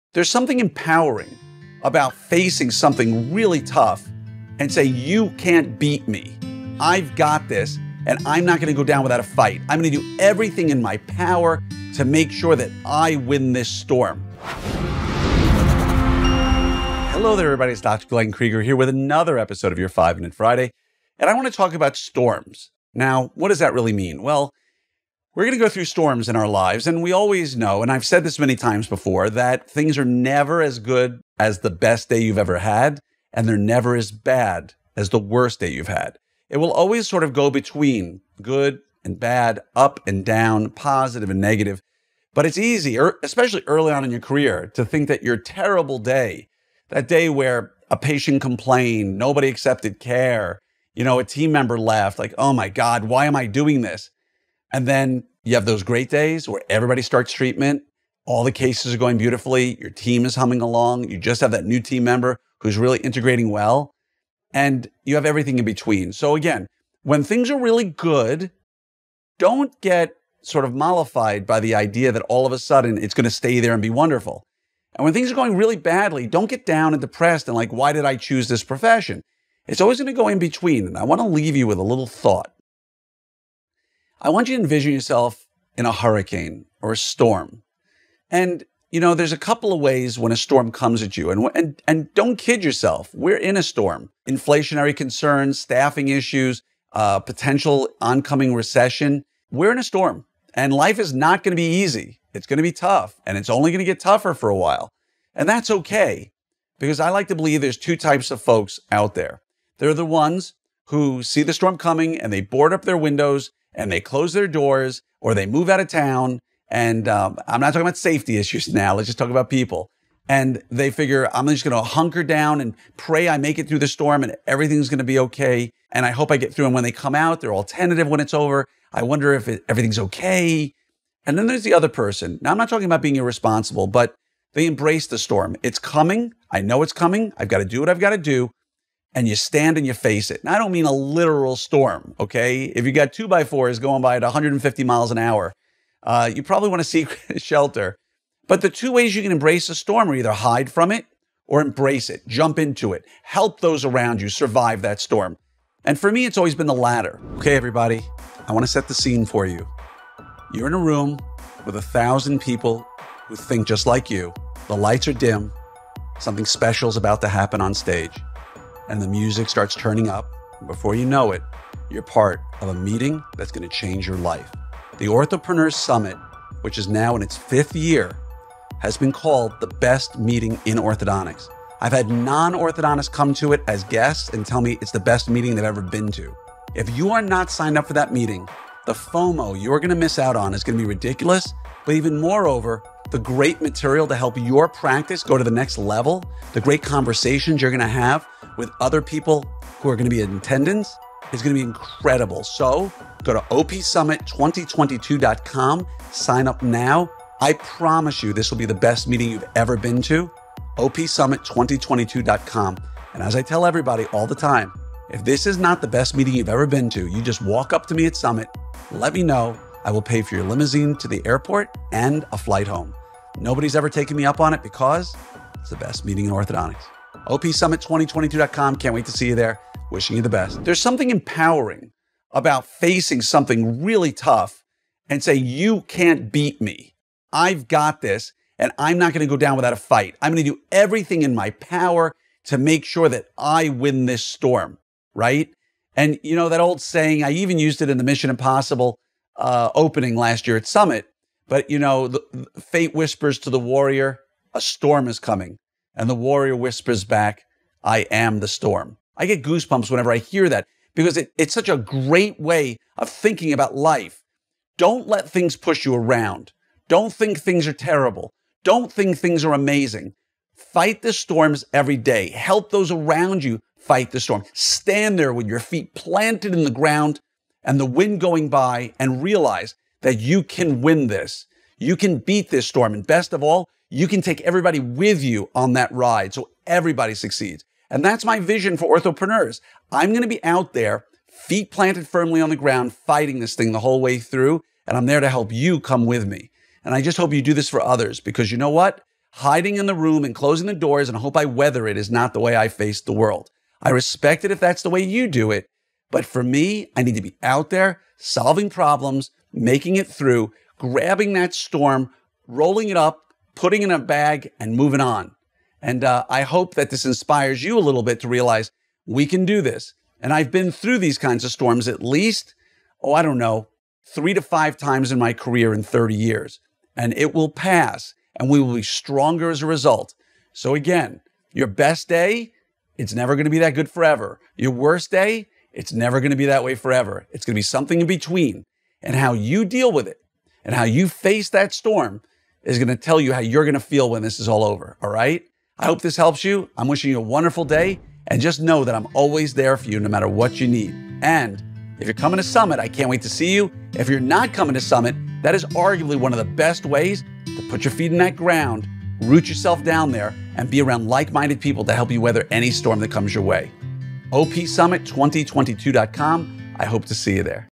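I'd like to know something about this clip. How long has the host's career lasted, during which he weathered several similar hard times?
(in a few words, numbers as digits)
30 years.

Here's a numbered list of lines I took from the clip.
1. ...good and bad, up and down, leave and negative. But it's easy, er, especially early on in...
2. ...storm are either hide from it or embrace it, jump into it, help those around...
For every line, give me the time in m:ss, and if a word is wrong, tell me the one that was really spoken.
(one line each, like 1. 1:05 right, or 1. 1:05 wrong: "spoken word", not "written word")
1. 0:38 wrong: "positive", not "leave"
2. 2:29 right.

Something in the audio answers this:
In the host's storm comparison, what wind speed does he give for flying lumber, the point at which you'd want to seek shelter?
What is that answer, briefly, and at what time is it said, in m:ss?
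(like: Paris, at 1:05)
150 miles an hour, at 2:24.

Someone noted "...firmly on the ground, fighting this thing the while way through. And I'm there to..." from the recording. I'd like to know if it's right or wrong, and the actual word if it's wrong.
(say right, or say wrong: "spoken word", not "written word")
wrong: "whole", not "while".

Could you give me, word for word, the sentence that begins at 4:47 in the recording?
And that's my vision for orthopreneurs.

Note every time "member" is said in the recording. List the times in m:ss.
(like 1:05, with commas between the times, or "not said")
0:51, 1:02.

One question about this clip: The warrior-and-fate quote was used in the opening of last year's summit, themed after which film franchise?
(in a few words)
Mission Impossible.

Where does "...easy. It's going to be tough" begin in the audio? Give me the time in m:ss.
1:41.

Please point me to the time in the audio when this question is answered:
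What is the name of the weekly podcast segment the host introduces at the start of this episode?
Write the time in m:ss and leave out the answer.
0:19.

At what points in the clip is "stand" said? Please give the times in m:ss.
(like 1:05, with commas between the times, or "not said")
2:19, 4:34.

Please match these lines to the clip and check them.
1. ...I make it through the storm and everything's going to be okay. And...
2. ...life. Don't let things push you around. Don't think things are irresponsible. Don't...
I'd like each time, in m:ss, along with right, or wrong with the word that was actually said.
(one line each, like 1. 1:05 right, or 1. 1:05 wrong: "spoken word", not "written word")
1. 2:03 right
2. 4:23 wrong: "terrible", not "irresponsible".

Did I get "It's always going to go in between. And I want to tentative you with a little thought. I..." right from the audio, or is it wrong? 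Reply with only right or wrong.
wrong.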